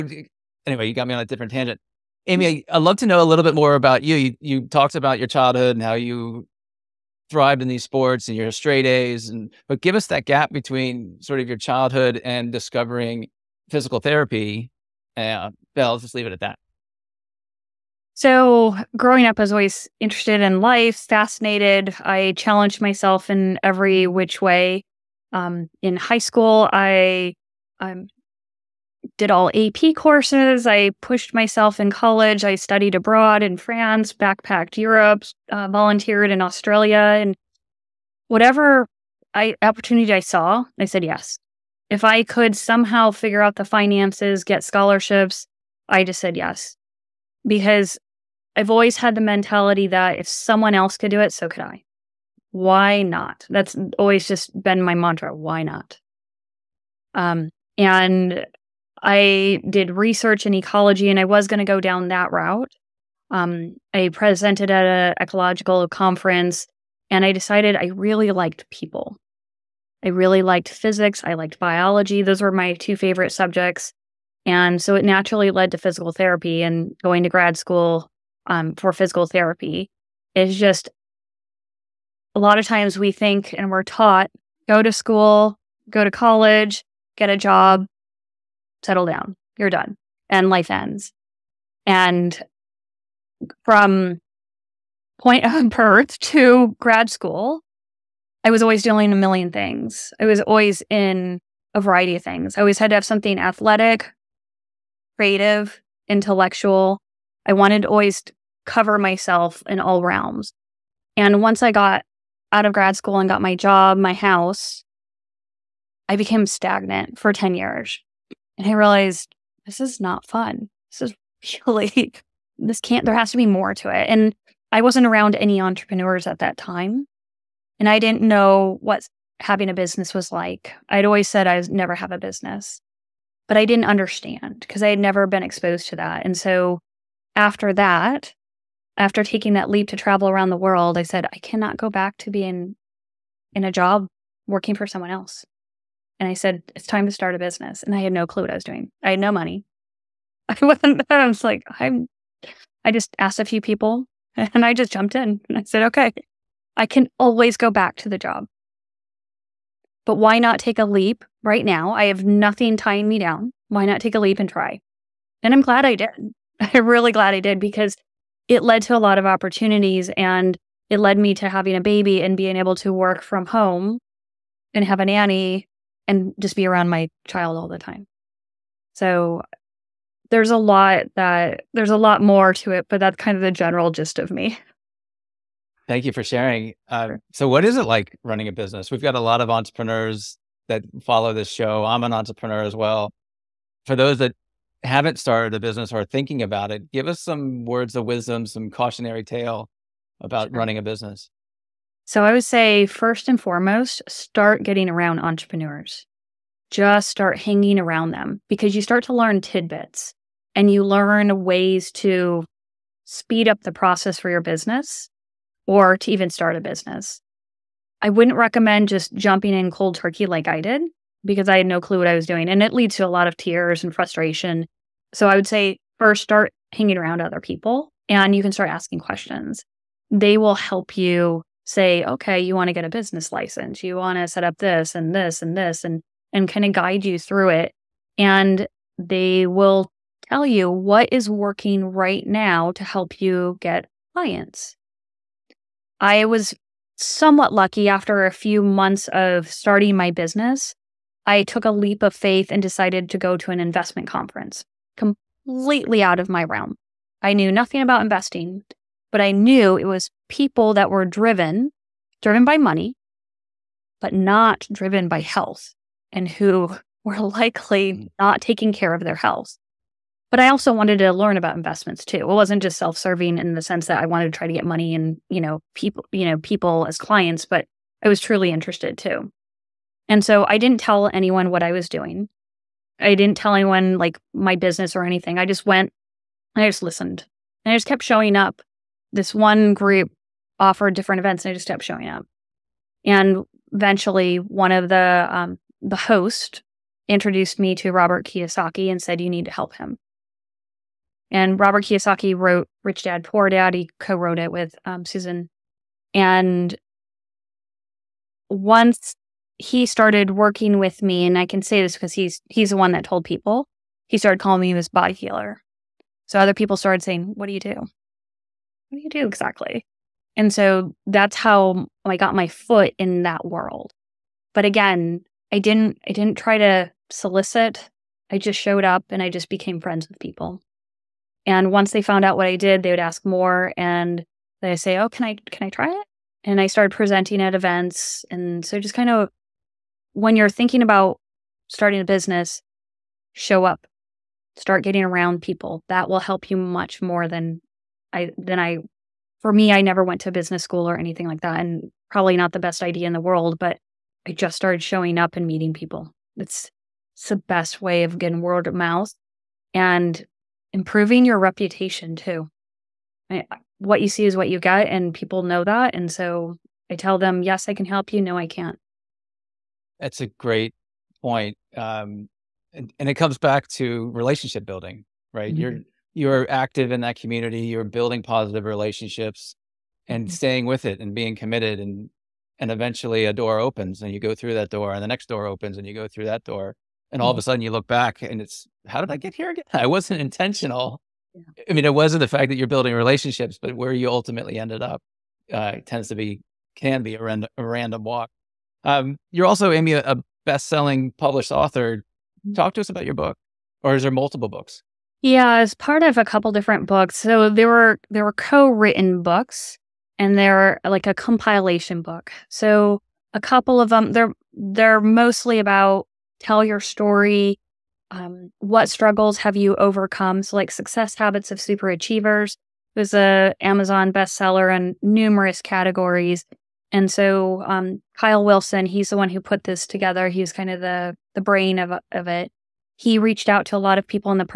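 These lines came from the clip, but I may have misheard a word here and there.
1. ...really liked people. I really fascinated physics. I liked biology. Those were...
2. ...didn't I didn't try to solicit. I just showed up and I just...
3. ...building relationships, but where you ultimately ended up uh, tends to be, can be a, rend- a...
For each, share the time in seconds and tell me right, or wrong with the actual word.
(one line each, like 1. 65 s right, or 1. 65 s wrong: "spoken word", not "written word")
1. 67 s wrong: "liked", not "fascinated"
2. 325 s right
3. 392 s right.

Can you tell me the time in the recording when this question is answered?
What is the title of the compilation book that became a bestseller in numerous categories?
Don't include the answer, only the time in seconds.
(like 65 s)
420 s.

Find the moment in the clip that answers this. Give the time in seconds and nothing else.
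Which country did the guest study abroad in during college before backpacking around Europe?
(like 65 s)
33 s.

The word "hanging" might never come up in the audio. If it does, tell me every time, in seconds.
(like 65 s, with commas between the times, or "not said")
207 s, 226 s.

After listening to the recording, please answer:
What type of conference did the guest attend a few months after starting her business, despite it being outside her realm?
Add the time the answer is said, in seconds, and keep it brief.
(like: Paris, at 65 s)
Investment conference, at 253 s.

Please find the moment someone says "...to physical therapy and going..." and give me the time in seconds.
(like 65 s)
75 s.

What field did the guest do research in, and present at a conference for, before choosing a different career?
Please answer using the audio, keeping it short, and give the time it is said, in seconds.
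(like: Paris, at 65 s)
Ecology, at 60 s.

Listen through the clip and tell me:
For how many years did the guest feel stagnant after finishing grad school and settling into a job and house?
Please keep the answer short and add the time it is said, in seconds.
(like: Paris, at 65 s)
10, at 117 s.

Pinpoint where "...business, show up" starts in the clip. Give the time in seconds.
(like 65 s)
342 s.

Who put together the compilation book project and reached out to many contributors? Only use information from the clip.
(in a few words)
Kyle Wilson.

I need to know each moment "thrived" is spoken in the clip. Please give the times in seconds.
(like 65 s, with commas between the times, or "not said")
7 s.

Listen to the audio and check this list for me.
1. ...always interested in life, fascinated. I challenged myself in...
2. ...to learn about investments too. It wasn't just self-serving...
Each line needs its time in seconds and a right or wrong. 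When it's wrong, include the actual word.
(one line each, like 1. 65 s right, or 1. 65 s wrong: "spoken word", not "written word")
1. 19 s right
2. 270 s right.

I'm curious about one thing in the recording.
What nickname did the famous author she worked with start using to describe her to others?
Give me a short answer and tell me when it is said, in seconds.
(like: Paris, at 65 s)
Body healer, at 314 s.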